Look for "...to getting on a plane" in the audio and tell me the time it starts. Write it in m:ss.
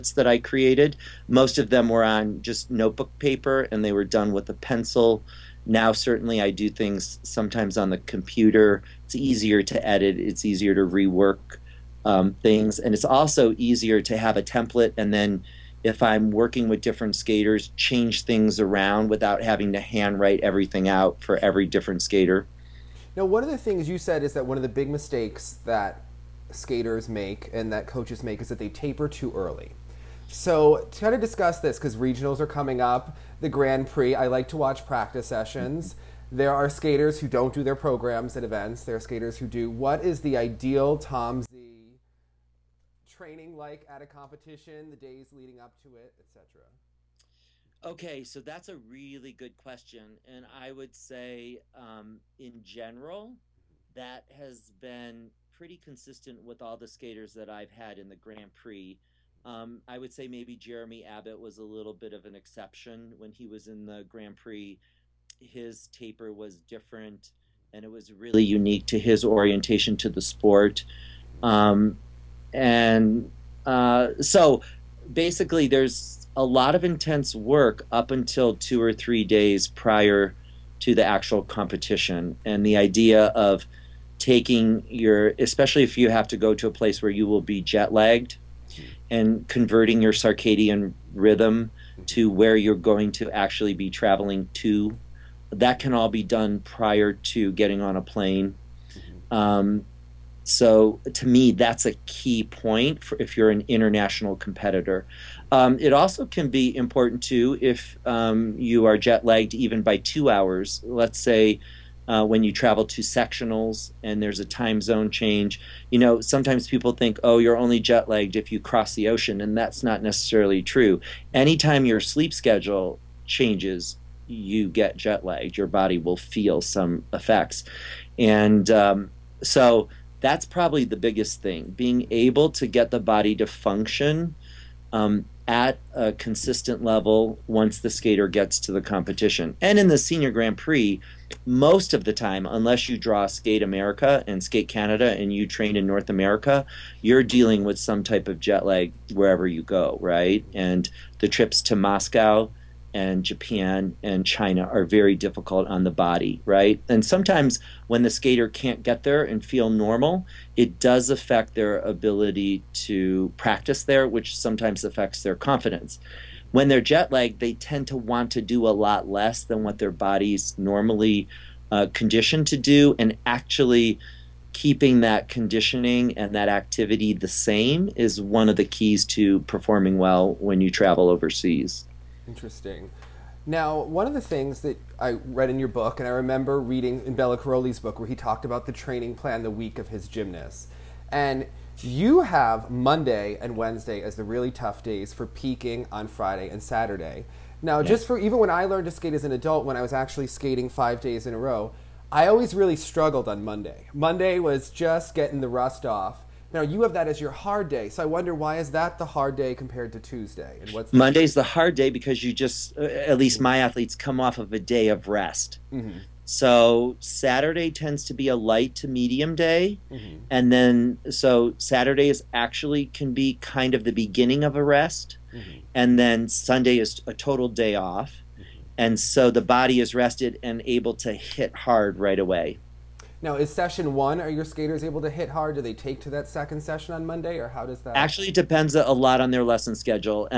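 1:37.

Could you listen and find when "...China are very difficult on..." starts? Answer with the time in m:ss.
2:34.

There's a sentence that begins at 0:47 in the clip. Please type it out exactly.
Okay, so that's a really good question.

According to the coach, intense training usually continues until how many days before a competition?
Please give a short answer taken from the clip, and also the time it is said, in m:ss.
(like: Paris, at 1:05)
2 or 3, at 1:18.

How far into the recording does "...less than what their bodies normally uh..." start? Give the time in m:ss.
2:49.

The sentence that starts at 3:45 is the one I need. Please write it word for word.
and then Sunday is a total day off, mm-hmm.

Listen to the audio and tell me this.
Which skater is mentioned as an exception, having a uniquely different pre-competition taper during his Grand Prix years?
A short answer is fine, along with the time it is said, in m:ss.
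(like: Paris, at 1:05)
Jeremy Abbott, at 1:00.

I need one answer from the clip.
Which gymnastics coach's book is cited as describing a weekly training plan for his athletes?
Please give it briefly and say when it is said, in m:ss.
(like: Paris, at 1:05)
Bela Karolyi, at 3:07.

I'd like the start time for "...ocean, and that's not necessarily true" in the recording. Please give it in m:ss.
1:59.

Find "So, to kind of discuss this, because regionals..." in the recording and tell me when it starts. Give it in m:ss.
0:30.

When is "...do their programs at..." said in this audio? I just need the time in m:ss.
0:37.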